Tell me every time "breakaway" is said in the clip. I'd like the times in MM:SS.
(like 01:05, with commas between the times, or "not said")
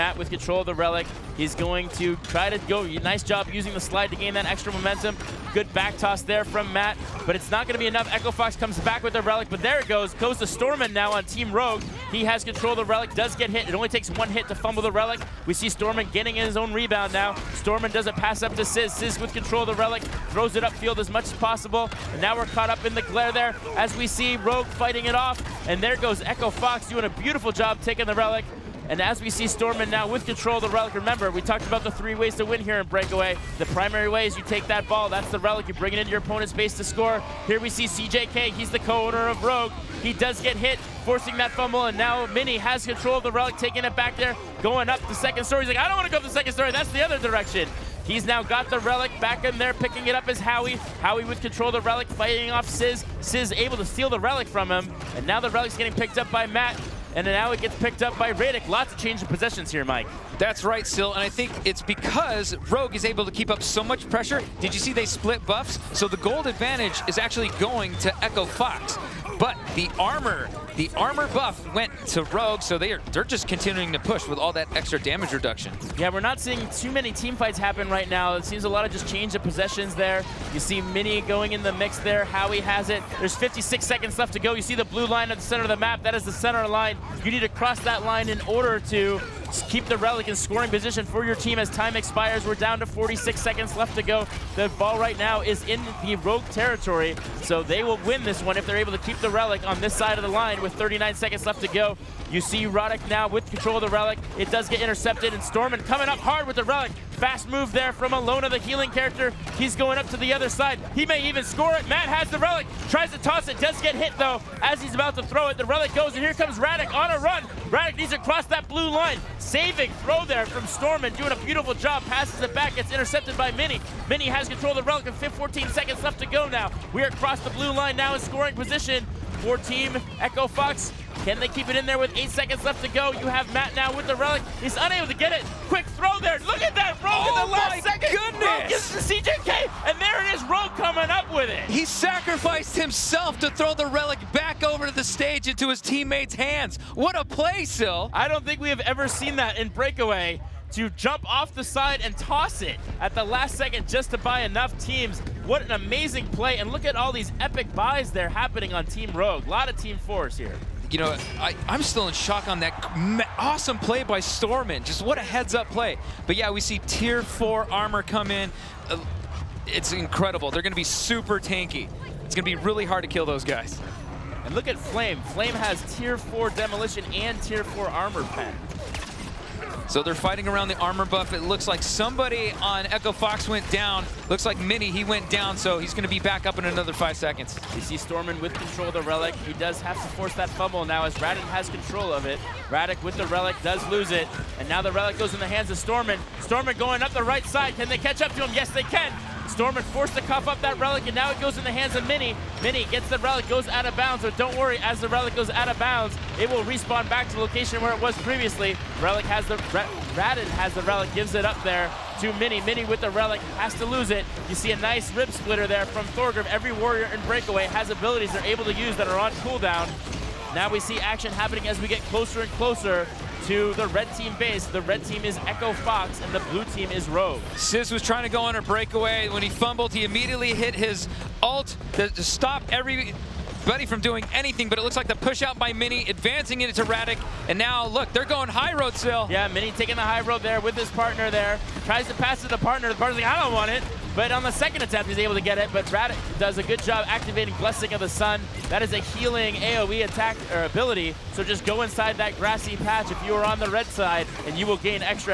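00:32, 02:29, 03:37, 03:48.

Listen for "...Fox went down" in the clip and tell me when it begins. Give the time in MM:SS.
03:03.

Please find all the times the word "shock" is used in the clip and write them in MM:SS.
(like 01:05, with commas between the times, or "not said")
02:42.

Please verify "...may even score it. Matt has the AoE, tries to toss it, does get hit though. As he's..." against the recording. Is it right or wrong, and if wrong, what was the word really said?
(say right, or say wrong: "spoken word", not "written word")
wrong: "Relic", not "AoE".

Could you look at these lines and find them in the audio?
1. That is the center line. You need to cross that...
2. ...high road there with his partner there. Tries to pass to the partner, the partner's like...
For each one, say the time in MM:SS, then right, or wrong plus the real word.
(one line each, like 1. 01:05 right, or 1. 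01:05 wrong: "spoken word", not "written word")
1. 01:26 right
2. 04:00 right.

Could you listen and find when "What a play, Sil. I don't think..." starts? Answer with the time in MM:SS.
02:26.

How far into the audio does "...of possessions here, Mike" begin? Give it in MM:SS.
00:59.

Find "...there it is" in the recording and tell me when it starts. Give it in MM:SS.
02:20.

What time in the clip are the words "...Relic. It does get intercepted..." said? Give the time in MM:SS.
01:43.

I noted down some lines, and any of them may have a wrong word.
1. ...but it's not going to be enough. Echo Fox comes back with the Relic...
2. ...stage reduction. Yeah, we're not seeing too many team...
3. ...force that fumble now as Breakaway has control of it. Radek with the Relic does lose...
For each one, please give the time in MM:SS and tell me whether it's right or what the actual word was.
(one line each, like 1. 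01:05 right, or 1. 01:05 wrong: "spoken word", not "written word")
1. 00:07 right
2. 01:14 wrong: "damage", not "stage"
3. 03:10 wrong: "Radek", not "Breakaway".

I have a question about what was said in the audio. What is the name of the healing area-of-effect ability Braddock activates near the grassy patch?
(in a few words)
Blessing of the Sun.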